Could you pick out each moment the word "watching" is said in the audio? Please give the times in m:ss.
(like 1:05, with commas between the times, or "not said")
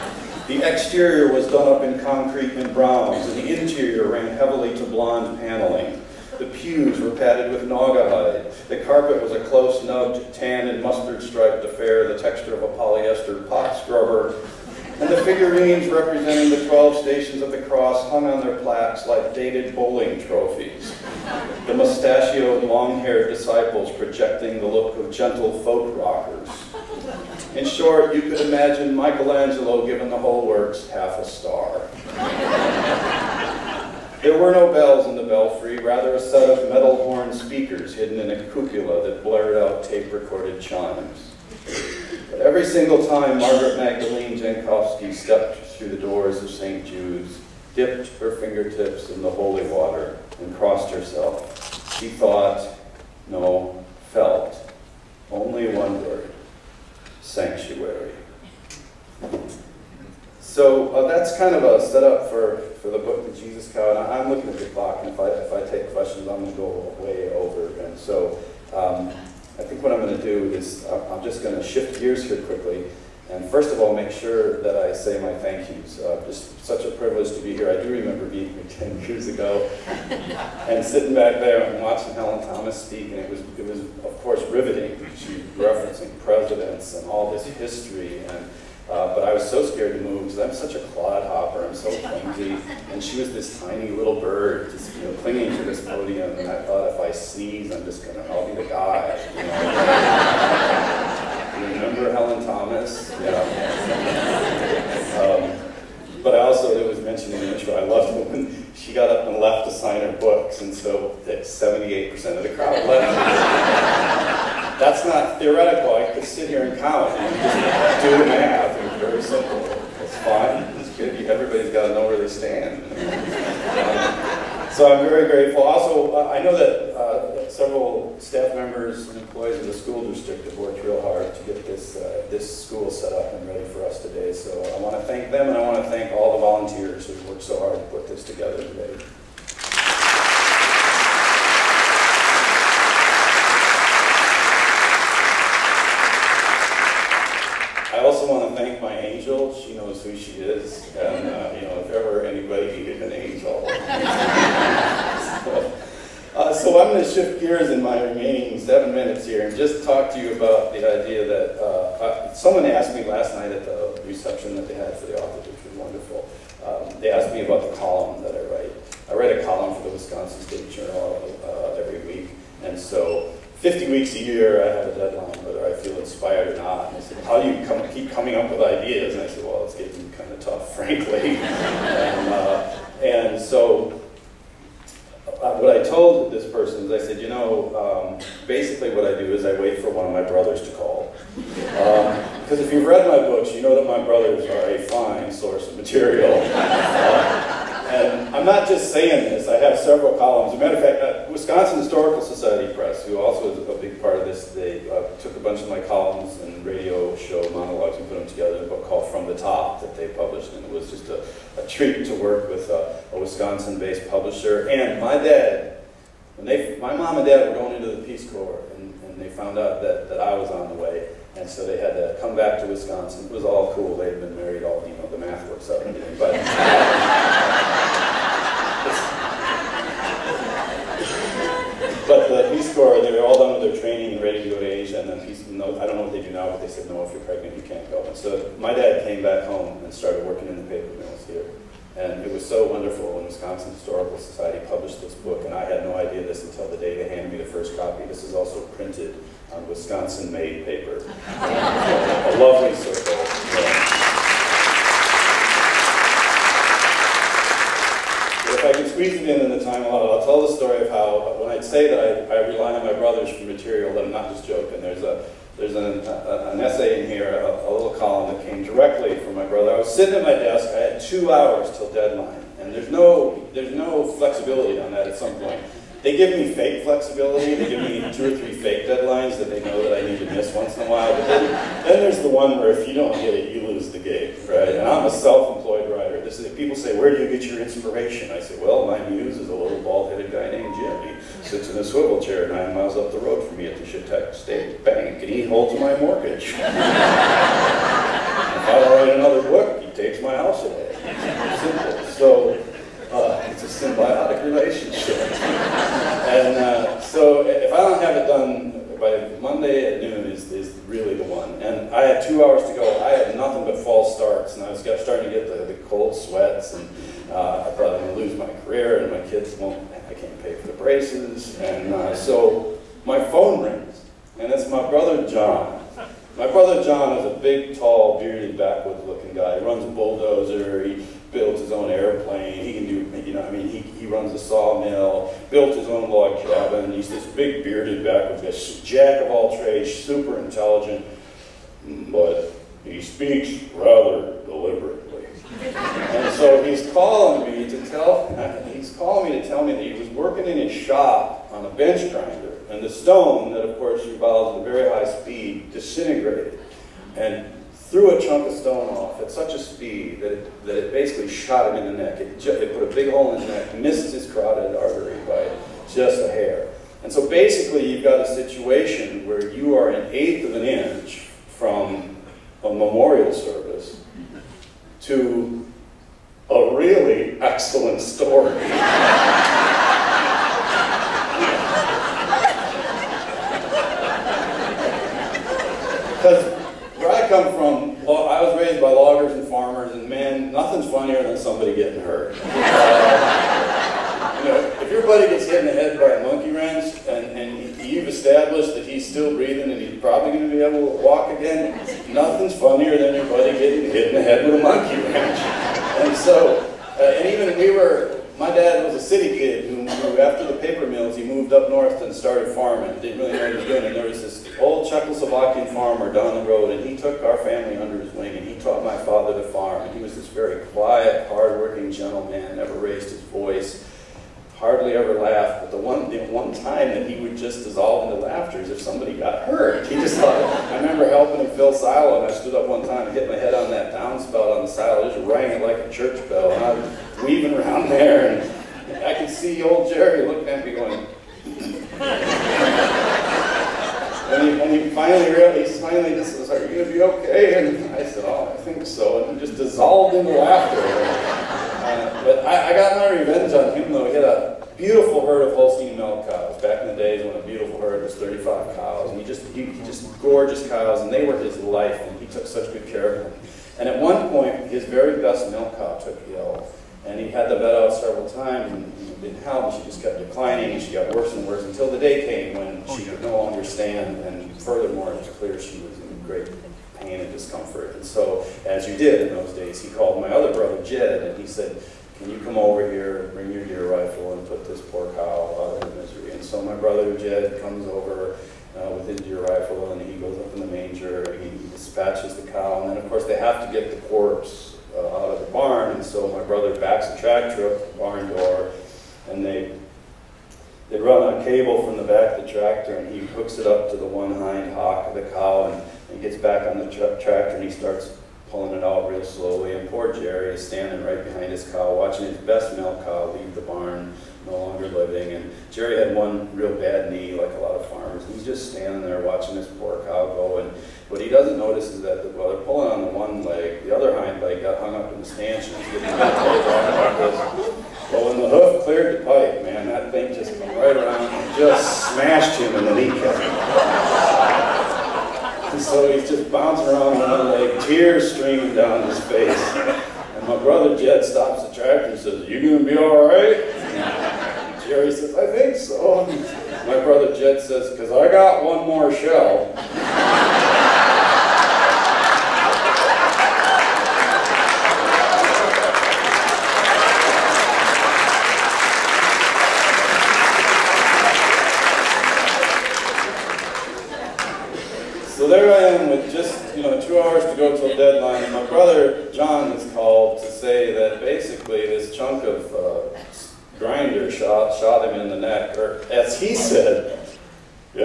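1:21, 8:31, 8:39.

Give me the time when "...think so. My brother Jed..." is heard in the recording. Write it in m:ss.
9:05.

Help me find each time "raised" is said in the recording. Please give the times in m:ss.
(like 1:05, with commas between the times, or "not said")
6:28, 7:02.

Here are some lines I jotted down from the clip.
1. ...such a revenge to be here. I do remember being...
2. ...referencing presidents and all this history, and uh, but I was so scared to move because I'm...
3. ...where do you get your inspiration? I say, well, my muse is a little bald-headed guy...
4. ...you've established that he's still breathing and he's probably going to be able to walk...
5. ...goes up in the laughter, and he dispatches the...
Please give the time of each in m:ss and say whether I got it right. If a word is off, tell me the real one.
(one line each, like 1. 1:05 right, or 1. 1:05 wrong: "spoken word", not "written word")
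1. 1:16 wrong: "privilege", not "revenge"
2. 1:25 right
3. 4:46 right
4. 6:37 right
5. 8:10 wrong: "manger", not "laughter".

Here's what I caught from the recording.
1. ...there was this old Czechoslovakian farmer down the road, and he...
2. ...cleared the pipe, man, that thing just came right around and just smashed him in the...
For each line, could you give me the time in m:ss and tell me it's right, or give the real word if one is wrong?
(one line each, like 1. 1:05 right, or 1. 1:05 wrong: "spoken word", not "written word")
1. 6:53 right
2. 8:48 right.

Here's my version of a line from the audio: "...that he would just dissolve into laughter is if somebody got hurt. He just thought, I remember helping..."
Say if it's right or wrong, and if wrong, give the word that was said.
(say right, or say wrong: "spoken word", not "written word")
right.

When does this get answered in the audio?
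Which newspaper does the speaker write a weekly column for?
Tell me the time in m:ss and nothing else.
2:49.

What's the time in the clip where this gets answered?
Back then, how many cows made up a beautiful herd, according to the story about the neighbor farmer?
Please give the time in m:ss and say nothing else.
7:38.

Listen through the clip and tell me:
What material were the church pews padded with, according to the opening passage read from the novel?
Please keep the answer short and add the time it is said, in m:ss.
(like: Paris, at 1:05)
Naugahyde, at 0:07.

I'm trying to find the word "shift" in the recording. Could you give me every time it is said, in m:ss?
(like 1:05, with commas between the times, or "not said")
1:11, 2:37.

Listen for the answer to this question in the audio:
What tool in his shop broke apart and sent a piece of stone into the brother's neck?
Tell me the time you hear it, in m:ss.
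5:51.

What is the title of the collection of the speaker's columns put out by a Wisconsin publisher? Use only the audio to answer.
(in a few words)
From the Top.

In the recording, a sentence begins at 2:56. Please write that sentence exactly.
And they said, how do you come, keep coming up with ideas?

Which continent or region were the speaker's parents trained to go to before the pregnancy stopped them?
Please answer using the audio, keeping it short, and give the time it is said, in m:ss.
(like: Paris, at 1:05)
Asia, at 3:54.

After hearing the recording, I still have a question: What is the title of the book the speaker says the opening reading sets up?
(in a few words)
The Jesus Cow.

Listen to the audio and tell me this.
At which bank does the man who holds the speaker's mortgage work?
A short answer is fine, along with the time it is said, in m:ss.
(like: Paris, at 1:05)
Chetek State Bank, at 4:53.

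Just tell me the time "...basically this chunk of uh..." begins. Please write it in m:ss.
9:31.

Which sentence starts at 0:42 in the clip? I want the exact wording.
But every single time Margaret Magdalene Jankowski stepped through the doors of St.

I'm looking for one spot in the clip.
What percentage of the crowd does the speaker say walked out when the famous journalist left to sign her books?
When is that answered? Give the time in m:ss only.
1:51.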